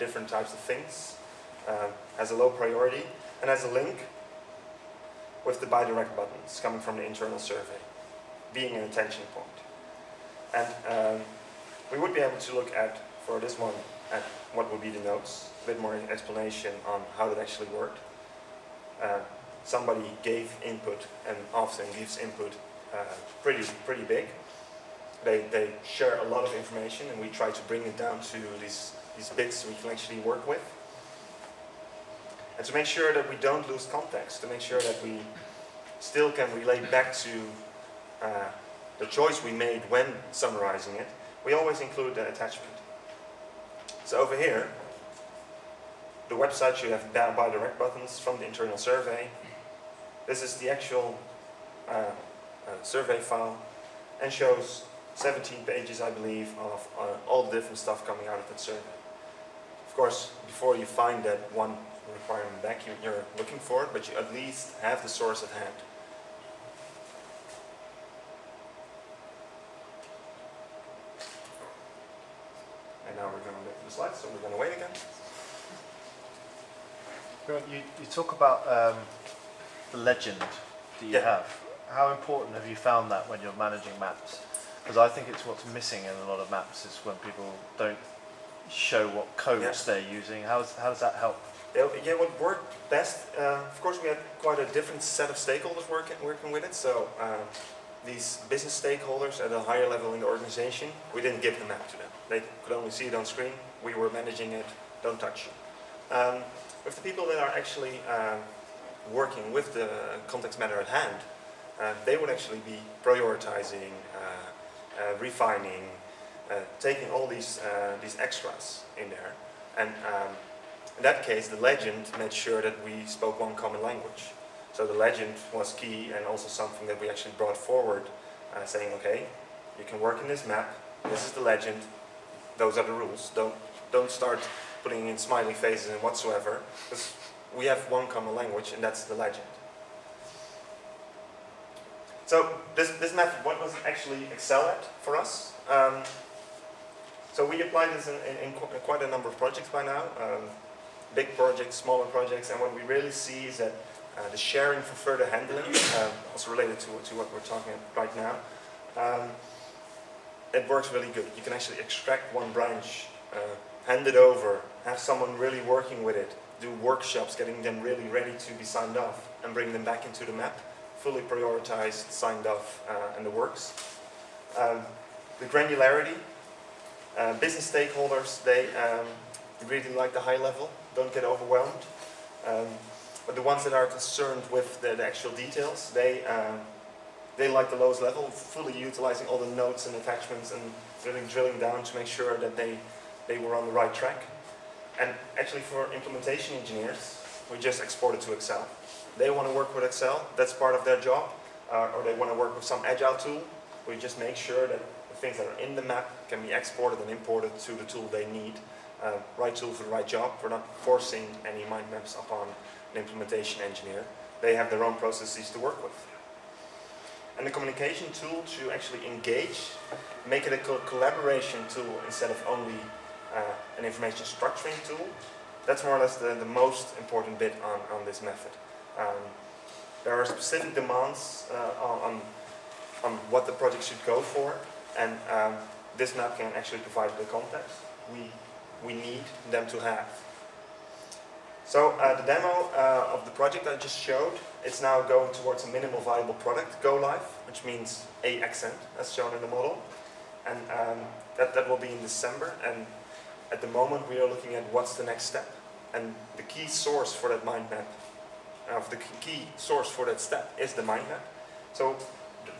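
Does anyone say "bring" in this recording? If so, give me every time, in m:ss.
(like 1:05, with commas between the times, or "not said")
0:27, 2:49.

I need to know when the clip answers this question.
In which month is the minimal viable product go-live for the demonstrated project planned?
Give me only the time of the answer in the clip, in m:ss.
4:12.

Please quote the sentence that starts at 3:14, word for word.
And actually for implementation engineers, we just export it to Excel.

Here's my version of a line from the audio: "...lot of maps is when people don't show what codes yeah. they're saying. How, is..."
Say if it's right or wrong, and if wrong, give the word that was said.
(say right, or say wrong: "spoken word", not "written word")
wrong: "using", not "saying".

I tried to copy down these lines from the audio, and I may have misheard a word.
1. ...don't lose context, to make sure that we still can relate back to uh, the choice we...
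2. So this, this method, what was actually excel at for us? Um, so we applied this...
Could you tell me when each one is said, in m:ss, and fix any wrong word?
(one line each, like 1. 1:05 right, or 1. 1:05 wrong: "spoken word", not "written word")
1. 0:33 right
2. 2:22 right.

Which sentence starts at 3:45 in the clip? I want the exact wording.
That's more or less the, the most important bit on, on this method.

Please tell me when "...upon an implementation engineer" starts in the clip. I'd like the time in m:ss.
3:32.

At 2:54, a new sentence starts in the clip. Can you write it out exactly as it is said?
Um, the granularity, uh, business stakeholders, they um, really like the high level, don't get overwhelmed.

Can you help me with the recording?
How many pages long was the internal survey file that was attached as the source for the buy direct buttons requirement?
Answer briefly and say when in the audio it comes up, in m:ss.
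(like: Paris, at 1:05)
17, at 0:55.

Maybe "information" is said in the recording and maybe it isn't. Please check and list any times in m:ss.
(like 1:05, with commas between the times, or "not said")
0:26, 3:43.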